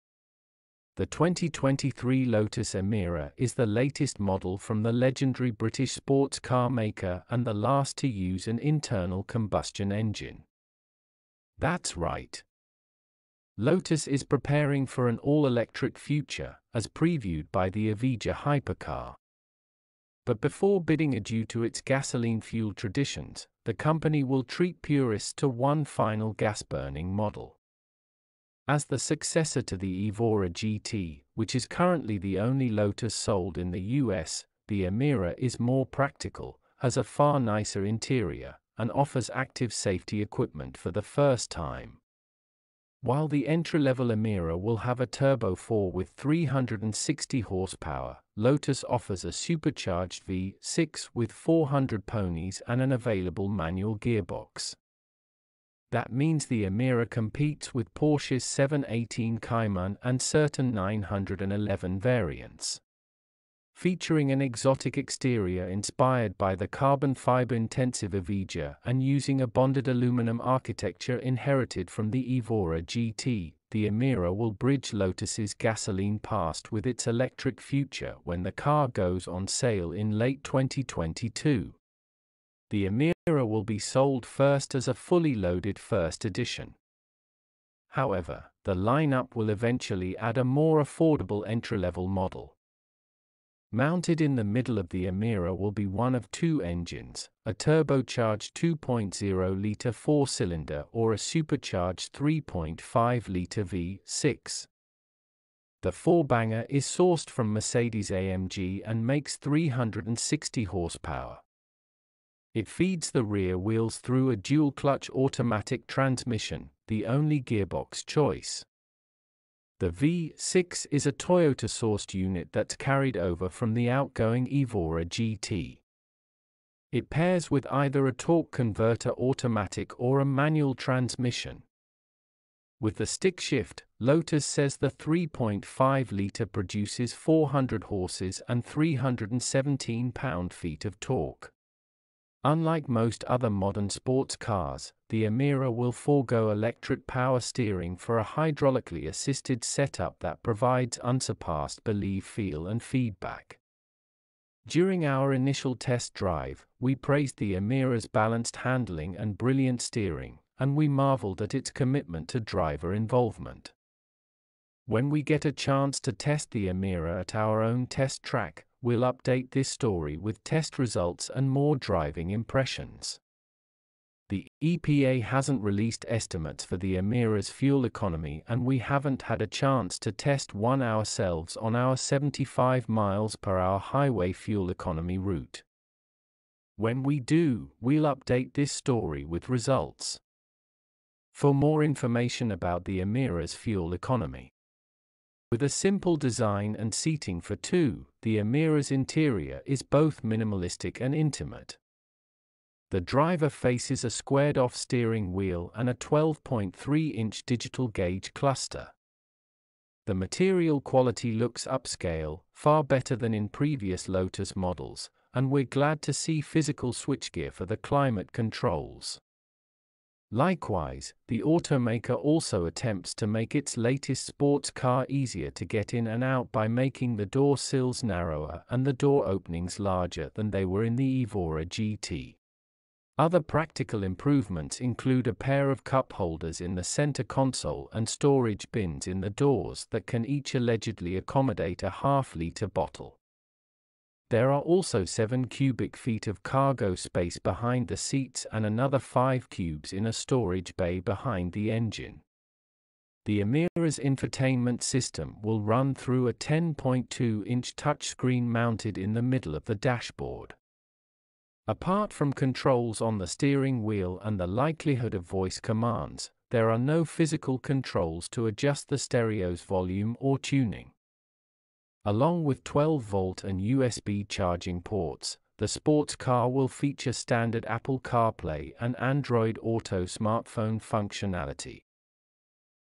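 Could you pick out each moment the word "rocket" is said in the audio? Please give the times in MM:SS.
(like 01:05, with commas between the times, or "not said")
not said.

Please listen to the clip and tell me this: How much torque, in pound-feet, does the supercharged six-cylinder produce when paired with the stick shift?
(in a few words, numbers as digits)
317.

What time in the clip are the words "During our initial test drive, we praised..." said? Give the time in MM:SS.
02:34.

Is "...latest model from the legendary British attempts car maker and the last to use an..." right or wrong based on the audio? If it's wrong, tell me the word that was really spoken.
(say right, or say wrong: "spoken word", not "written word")
wrong: "sports", not "attempts".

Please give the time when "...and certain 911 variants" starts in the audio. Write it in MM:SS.
01:00.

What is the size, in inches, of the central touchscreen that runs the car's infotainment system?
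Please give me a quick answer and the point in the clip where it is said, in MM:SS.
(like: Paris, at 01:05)
10.2 inches, at 04:16.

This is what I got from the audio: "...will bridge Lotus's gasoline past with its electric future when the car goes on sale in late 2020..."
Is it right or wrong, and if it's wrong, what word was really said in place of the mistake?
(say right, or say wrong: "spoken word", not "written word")
wrong: "2022", not "2020".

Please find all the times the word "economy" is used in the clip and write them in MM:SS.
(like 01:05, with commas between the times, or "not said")
02:57, 03:04, 03:13.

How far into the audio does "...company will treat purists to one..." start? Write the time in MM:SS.
00:23.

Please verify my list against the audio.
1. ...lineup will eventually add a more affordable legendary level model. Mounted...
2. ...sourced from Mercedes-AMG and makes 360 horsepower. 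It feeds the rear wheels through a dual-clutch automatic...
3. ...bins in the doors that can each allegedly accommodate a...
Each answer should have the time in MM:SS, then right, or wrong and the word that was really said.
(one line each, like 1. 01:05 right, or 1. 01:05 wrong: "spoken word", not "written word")
1. 01:28 wrong: "entry", not "legendary"
2. 01:46 right
3. 03:58 right.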